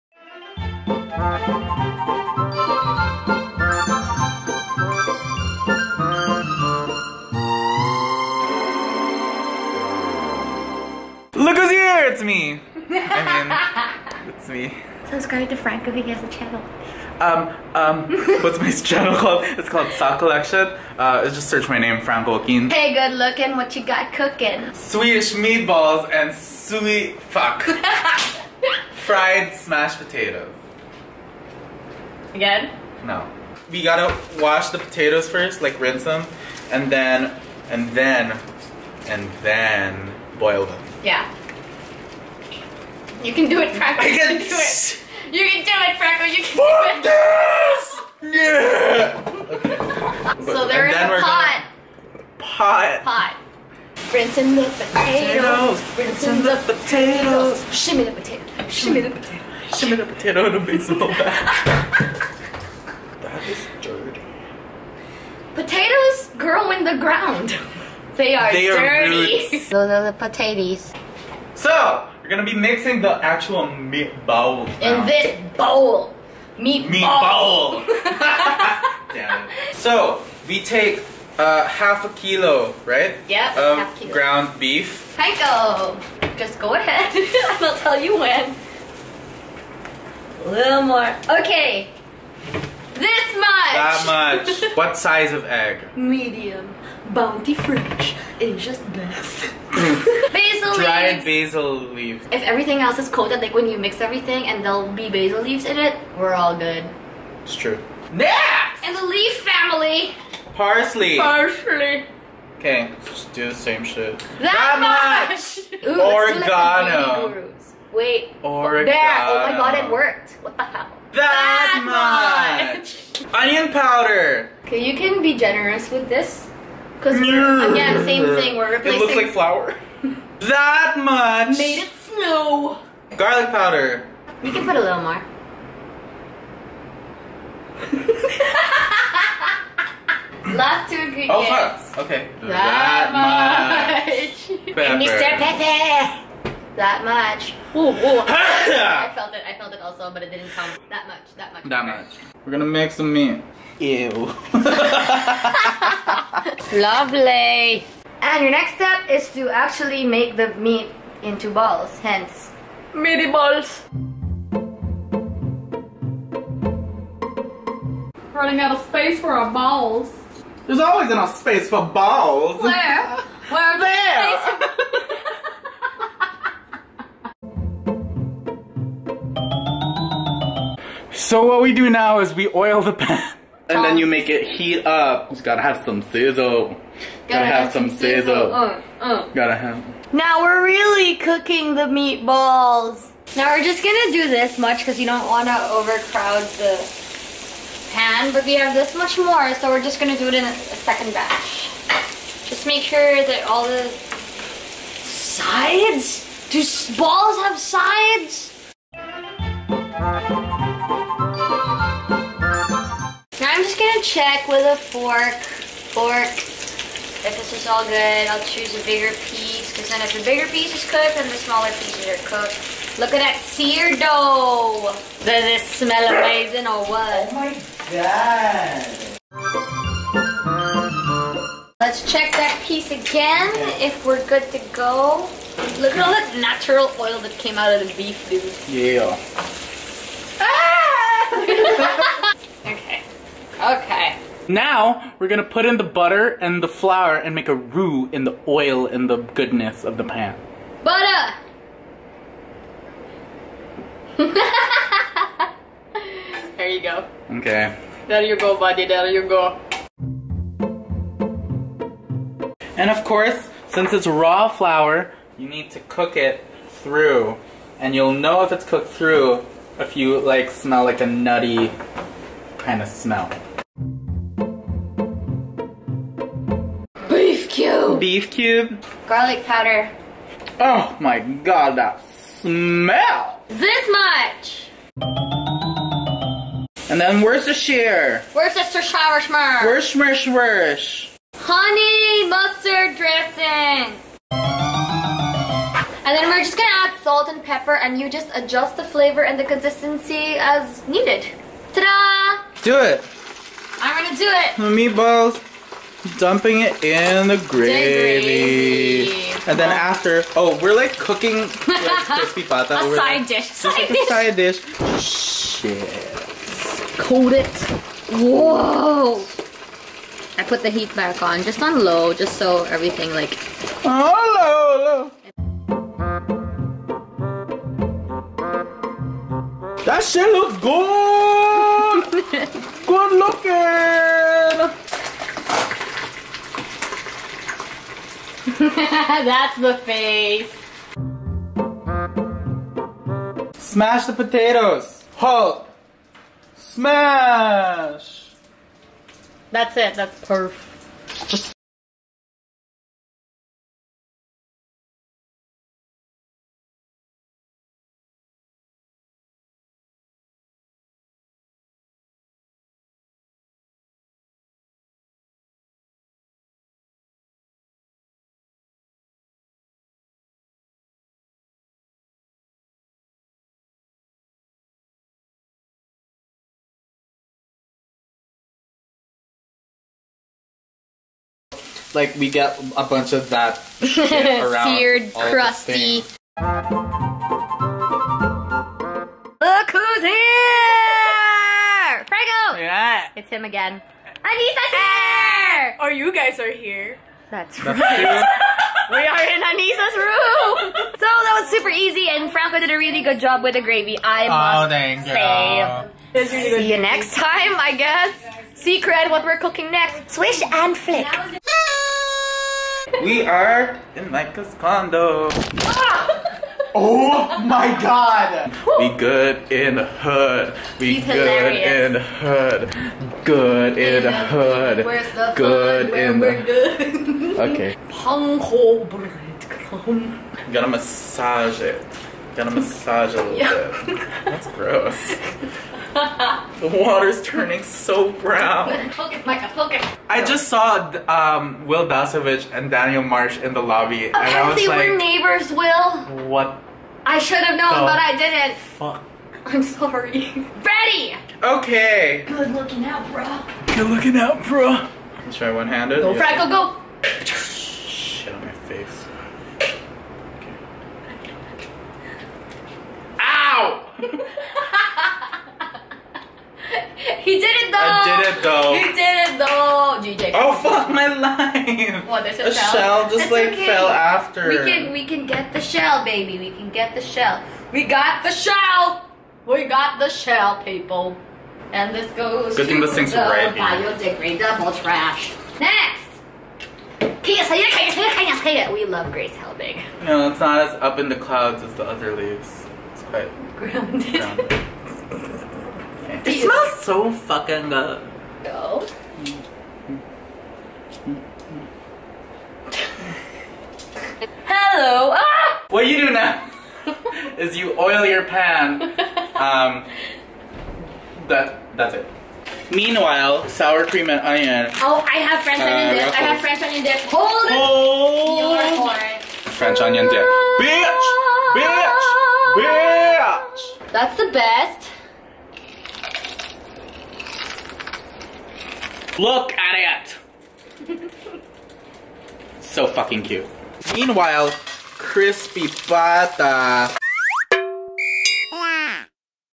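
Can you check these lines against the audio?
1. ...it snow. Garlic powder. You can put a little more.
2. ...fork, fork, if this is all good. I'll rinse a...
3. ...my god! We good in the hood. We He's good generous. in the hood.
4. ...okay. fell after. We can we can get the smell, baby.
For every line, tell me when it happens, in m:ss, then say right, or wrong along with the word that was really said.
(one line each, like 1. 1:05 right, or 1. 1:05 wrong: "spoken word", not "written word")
1. 2:11 right
2. 3:34 wrong: "choose", not "rinse"
3. 6:57 wrong: "hilarious", not "generous"
4. 7:53 wrong: "shell", not "smell".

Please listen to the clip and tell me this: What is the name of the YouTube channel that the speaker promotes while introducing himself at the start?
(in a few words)
Sock Collection.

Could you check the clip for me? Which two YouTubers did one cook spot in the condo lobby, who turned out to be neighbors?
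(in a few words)
Wil Dasovich and Daniel Marsh.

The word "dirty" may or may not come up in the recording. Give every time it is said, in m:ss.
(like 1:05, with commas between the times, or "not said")
1:03, 1:08.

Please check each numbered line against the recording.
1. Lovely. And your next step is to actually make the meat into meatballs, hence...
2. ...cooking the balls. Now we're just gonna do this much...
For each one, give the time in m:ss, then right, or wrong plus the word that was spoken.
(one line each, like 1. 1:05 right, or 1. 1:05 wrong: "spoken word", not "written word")
1. 2:36 wrong: "balls", not "meatballs"
2. 3:11 wrong: "meatballs", not "balls".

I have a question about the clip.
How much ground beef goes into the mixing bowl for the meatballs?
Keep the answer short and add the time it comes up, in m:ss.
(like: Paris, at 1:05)
half a kilo, at 1:21.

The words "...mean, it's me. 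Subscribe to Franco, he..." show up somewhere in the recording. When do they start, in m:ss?
0:14.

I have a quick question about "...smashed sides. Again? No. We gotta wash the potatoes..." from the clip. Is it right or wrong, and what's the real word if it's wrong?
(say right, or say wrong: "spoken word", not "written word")
wrong: "potatoes", not "sides".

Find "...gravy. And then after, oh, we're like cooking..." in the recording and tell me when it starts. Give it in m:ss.
5:08.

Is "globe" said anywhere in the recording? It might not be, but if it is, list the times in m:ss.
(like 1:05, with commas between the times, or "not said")
not said.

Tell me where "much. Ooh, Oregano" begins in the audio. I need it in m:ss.
1:55.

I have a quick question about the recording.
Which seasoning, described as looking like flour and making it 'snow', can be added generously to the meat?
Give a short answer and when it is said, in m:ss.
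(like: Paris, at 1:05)
Onion powder, at 2:03.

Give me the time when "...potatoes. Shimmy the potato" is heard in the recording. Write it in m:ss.
0:56.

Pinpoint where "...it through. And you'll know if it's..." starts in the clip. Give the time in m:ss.
4:26.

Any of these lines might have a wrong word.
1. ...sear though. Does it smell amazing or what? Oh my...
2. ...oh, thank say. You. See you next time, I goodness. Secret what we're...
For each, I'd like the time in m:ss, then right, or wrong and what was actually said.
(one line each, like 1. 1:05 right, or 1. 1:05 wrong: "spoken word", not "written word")
1. 3:43 wrong: "dough", not "though"
2. 6:44 wrong: "guess", not "goodness".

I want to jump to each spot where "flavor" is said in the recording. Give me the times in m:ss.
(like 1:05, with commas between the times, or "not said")
4:58.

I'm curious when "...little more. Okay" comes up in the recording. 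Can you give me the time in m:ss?
1:30.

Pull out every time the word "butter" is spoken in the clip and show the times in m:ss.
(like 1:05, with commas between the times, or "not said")
4:05, 4:10.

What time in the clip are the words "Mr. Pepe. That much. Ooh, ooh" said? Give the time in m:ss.
2:25.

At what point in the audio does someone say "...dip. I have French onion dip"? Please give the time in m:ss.
8:35.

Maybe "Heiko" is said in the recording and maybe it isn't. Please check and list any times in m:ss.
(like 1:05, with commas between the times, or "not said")
1:25.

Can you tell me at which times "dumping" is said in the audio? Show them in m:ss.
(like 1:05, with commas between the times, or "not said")
5:06.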